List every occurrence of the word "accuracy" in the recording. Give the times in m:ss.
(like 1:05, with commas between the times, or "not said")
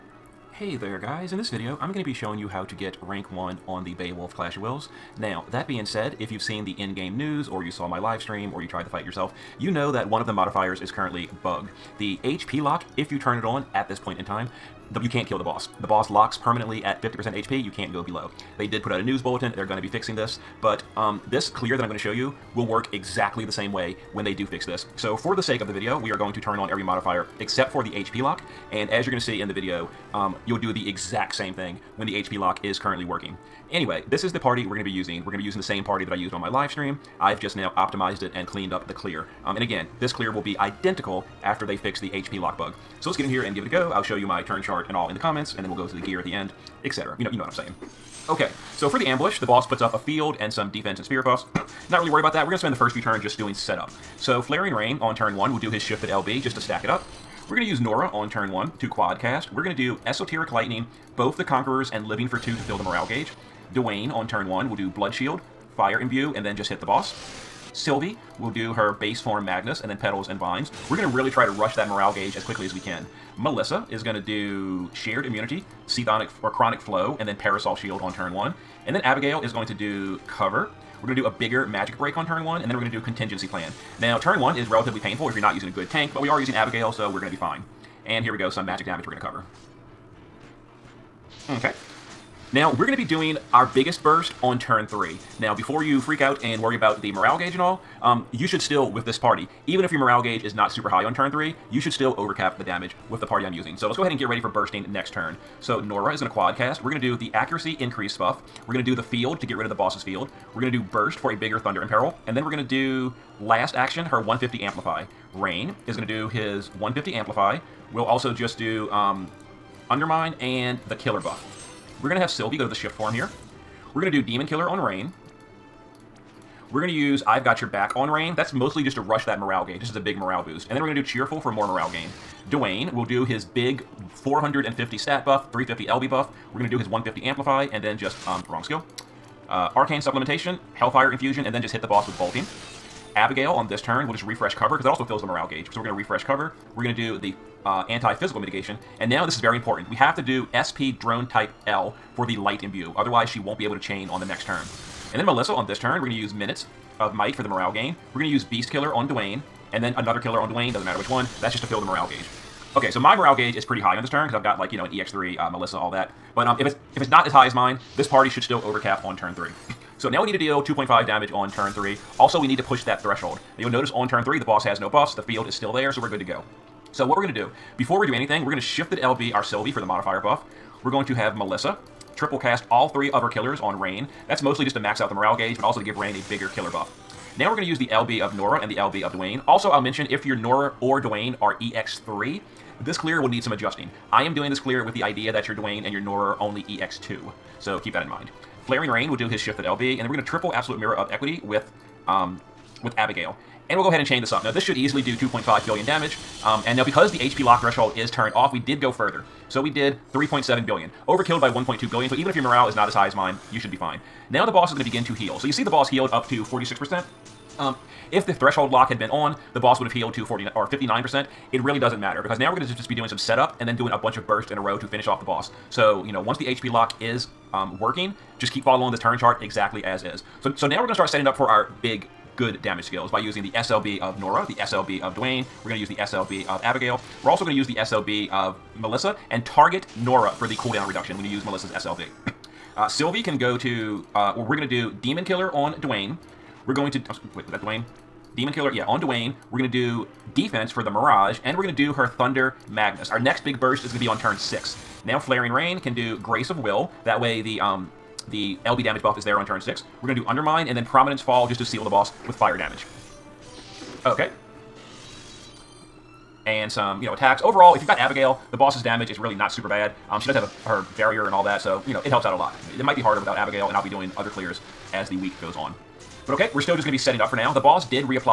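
1:47.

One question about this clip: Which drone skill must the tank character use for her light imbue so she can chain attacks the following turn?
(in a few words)
SP drone type L.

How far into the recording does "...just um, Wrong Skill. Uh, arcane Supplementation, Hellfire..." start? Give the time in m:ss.
2:17.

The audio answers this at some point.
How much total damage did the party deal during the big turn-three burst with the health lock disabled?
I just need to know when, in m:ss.
3:30.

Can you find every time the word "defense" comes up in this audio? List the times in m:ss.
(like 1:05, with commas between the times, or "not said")
0:50, 4:10.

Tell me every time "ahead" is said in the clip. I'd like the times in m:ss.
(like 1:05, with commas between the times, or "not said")
1:44, 3:23.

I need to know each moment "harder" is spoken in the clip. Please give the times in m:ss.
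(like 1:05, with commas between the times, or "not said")
4:33.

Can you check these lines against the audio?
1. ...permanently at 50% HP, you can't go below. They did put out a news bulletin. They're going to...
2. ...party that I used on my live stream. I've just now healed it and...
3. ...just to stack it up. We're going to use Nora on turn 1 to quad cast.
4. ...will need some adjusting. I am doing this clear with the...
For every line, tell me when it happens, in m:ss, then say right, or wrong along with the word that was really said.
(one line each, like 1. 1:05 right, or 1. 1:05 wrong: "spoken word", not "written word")
1. 0:16 right
2. 0:35 wrong: "optimized", not "healed"
3. 0:56 right
4. 3:13 right.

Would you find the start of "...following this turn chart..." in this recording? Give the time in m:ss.
3:48.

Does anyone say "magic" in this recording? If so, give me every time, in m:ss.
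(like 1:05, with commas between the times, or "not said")
1:21, 1:28.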